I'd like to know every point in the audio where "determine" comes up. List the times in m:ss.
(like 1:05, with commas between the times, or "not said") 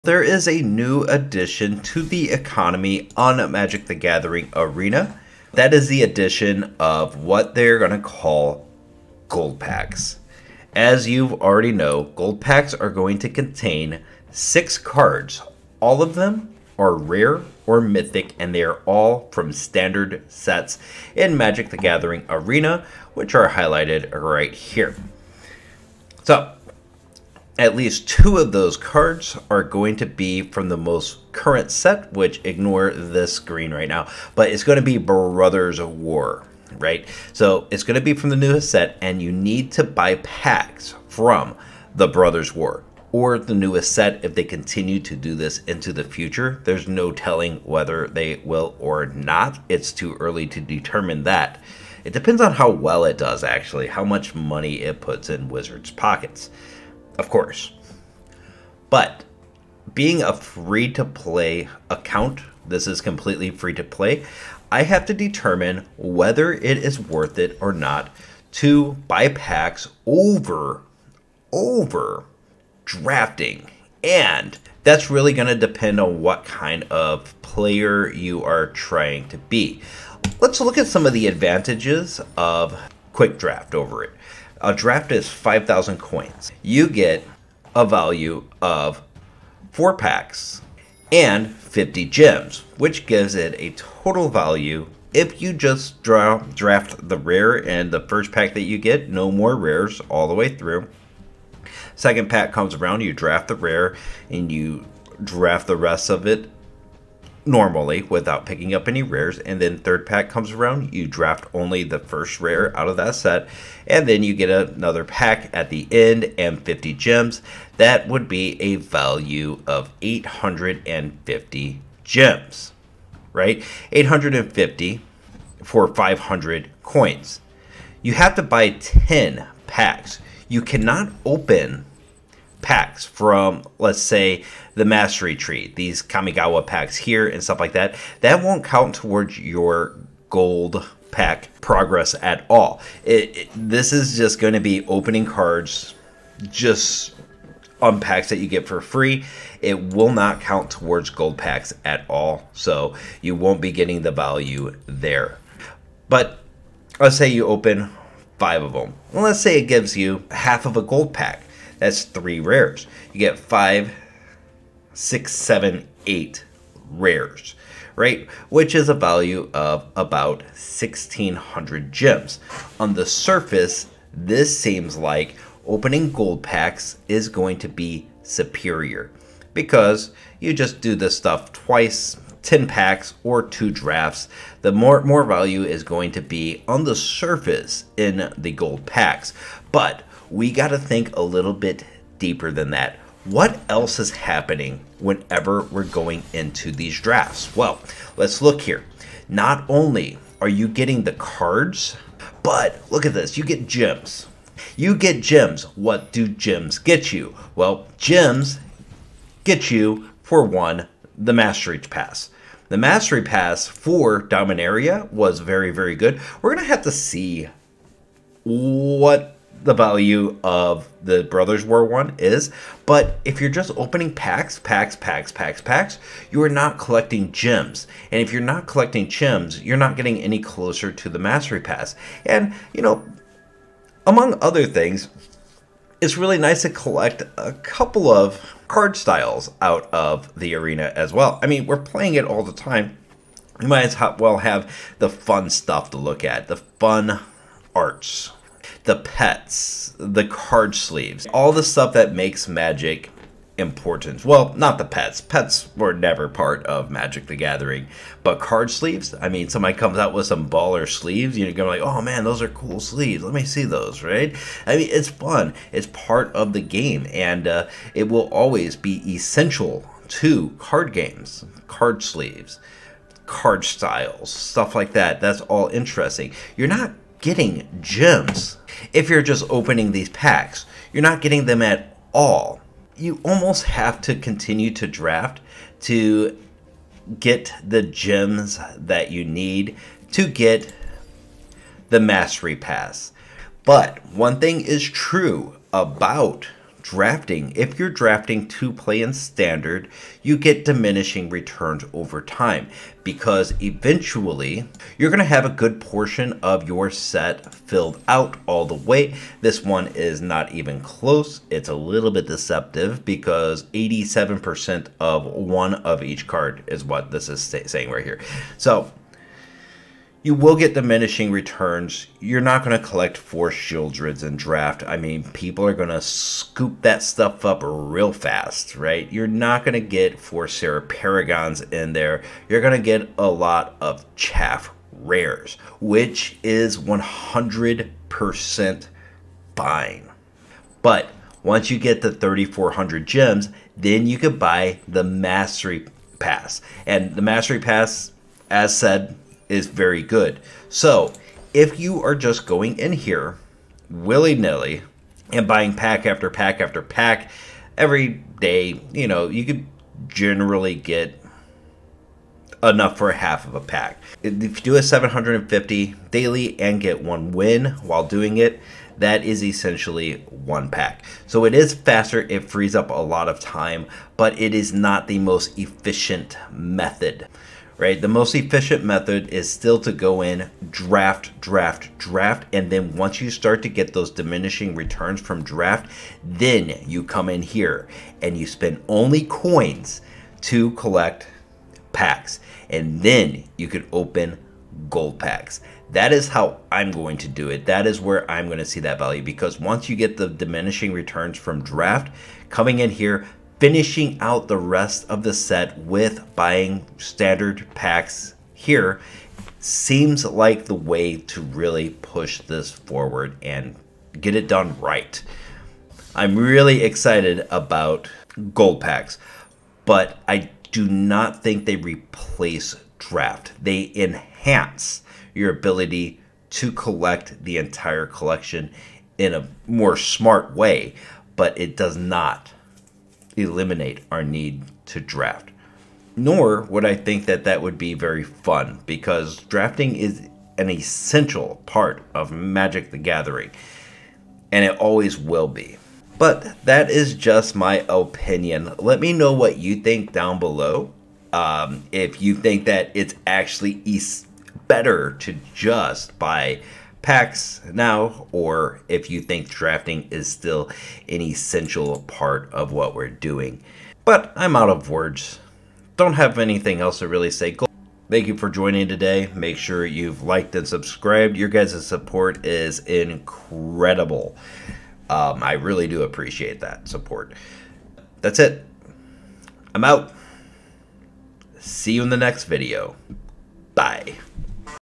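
0:50, 1:05.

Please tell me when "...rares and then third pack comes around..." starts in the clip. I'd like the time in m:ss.
1:49.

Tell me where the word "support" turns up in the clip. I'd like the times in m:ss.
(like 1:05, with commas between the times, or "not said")
7:51, 7:56.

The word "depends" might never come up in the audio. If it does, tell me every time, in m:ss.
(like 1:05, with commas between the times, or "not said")
0:52, 1:15.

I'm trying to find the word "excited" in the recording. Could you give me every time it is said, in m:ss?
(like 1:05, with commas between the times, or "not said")
6:56.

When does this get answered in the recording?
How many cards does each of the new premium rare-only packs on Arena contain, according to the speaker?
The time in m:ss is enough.
0:14.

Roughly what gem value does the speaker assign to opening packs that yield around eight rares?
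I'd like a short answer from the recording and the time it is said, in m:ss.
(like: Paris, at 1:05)
1,600 gems, at 2:50.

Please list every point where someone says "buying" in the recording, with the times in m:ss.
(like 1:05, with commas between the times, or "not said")
5:55, 6:46.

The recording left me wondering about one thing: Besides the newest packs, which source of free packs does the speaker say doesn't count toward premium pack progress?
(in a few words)
Mastery Tree.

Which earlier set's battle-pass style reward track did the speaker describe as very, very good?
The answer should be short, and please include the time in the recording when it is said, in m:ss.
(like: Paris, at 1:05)
Dominaria, at 3:34.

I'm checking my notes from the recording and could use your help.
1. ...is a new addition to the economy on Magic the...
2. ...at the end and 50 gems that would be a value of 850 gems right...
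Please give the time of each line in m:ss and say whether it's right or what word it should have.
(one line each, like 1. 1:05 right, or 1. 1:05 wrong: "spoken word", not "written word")
1. 0:00 right
2. 1:55 right.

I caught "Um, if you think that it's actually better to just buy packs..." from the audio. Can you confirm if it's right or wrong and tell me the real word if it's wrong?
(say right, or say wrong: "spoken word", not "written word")
right.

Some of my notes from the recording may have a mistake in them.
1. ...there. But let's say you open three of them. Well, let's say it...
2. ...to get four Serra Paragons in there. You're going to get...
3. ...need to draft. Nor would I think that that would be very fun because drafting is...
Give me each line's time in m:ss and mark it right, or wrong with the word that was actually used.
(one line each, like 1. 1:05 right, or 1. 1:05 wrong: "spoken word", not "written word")
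1. 2:34 wrong: "five", not "three"
2. 5:29 right
3. 7:14 right.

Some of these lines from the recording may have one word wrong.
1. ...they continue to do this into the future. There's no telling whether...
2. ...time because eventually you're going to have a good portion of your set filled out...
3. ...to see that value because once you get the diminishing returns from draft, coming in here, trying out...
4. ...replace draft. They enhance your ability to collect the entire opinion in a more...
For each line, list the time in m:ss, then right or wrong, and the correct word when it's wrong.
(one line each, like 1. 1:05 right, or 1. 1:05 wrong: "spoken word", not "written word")
1. 0:44 right
2. 5:02 right
3. 6:38 wrong: "finishing", not "trying"
4. 7:01 wrong: "collection", not "opinion".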